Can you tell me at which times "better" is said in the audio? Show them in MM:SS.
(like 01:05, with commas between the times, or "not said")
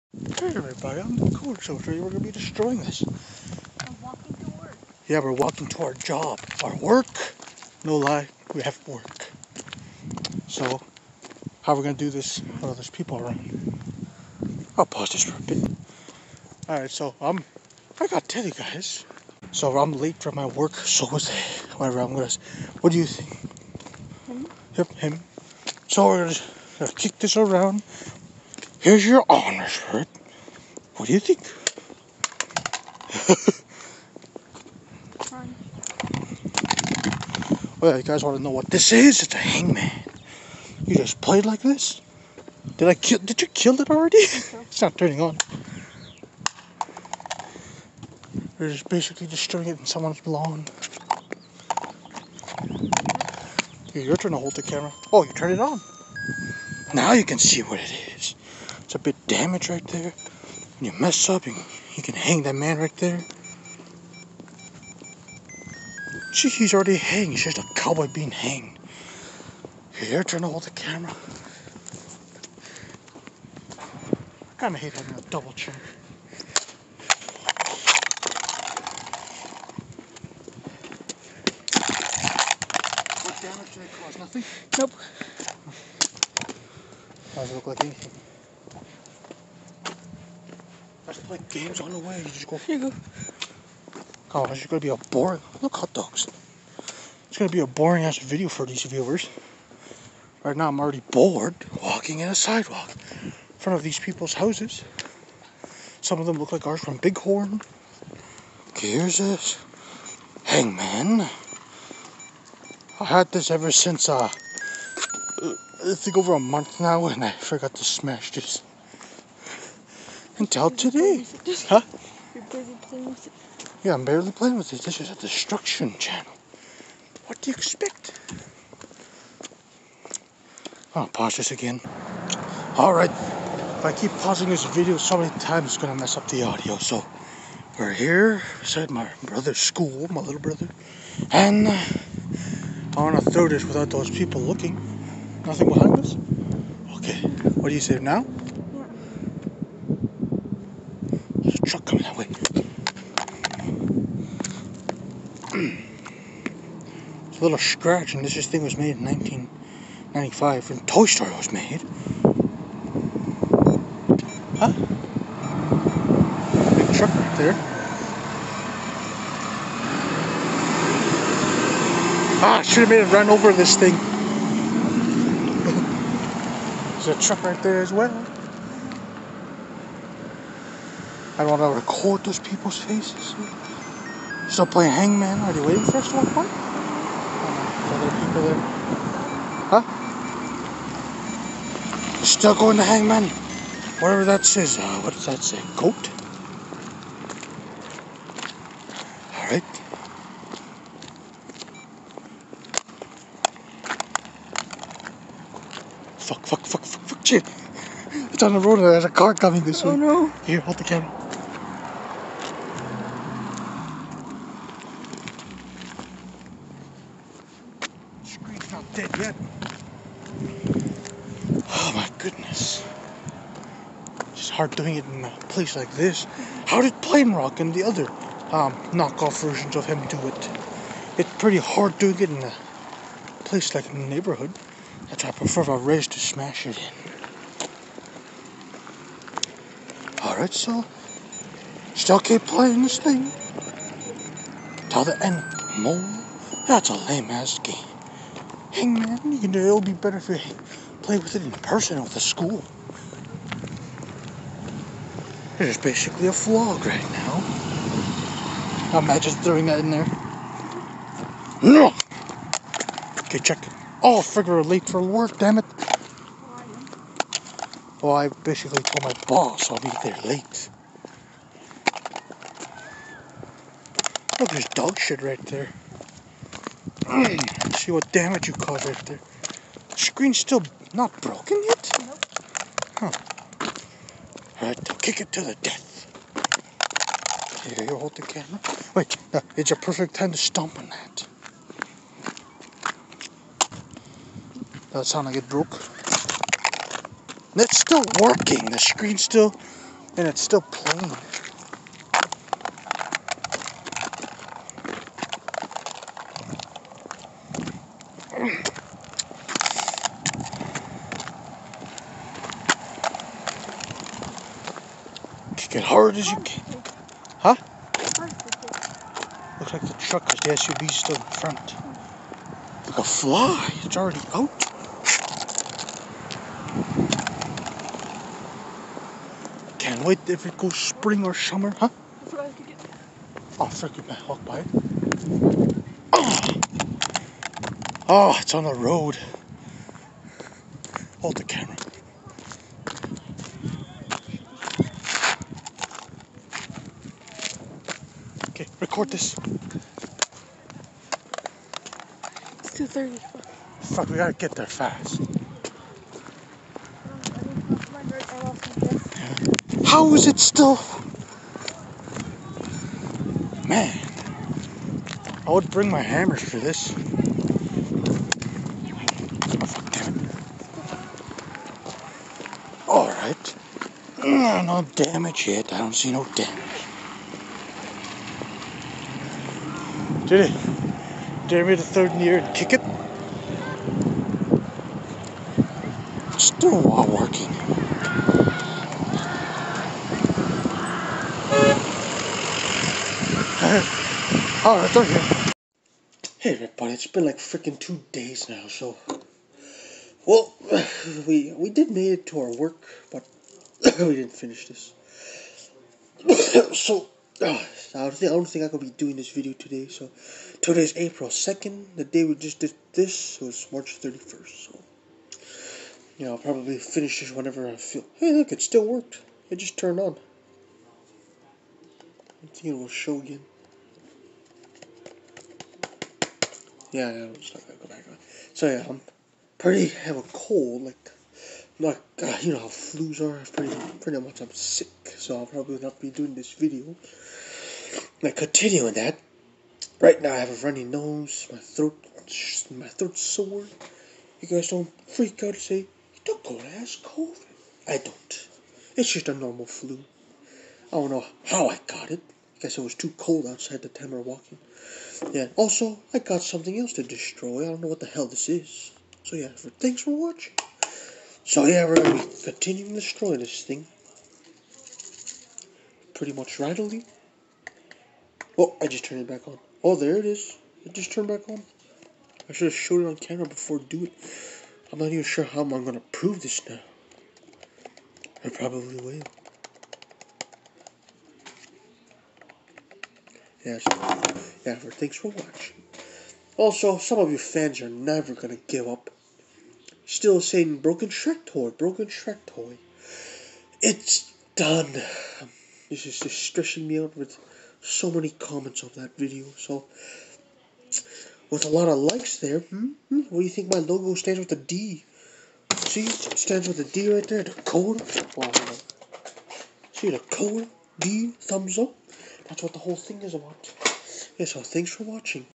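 04:09.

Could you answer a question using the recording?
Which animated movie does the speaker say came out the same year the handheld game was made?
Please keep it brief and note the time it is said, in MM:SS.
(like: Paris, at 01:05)
Toy Story, at 02:40.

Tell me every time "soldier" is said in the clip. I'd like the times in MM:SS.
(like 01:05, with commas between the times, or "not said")
00:01.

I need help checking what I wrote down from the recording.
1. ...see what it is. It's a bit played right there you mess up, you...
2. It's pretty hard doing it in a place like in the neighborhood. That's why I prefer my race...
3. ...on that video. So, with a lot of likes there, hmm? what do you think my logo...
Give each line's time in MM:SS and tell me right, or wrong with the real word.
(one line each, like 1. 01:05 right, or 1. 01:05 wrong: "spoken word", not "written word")
1. 00:57 wrong: "damaged", not "played"
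2. 03:51 right
3. 08:18 right.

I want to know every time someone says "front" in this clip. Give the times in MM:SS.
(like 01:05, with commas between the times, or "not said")
01:43, 05:21.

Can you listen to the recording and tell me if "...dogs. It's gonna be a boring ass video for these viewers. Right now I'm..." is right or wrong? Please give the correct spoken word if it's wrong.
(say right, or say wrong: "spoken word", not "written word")
right.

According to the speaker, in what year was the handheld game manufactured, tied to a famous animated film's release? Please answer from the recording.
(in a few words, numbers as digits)
1995.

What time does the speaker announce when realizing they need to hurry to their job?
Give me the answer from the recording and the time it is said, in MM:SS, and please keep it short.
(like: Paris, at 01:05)
2:30, at 05:52.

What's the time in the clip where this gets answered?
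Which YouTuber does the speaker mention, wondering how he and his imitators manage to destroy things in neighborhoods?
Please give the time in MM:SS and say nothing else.
03:46.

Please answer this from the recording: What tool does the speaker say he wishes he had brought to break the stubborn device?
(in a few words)
hammers.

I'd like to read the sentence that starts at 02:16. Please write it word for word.
So, we're here beside my brother's school, my little brother.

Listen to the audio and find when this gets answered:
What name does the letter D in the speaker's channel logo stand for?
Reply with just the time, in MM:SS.
08:27.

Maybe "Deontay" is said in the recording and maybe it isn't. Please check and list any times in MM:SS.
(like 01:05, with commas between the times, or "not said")
not said.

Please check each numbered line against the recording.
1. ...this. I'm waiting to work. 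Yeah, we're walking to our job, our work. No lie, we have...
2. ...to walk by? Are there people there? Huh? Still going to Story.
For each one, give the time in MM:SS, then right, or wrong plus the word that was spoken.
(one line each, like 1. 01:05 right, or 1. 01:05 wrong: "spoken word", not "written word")
1. 00:02 wrong: "walking", not "waiting"
2. 03:06 wrong: "Hangman", not "Story".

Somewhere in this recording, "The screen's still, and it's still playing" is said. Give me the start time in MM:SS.
04:58.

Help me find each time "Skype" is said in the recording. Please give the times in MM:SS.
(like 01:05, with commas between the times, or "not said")
not said.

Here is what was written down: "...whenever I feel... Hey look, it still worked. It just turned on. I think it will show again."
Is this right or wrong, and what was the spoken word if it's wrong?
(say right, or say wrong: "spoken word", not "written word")
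right.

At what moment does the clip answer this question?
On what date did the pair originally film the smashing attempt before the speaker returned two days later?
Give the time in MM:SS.
06:53.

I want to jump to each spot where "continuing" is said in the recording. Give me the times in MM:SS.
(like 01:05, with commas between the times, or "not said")
07:18, 07:42.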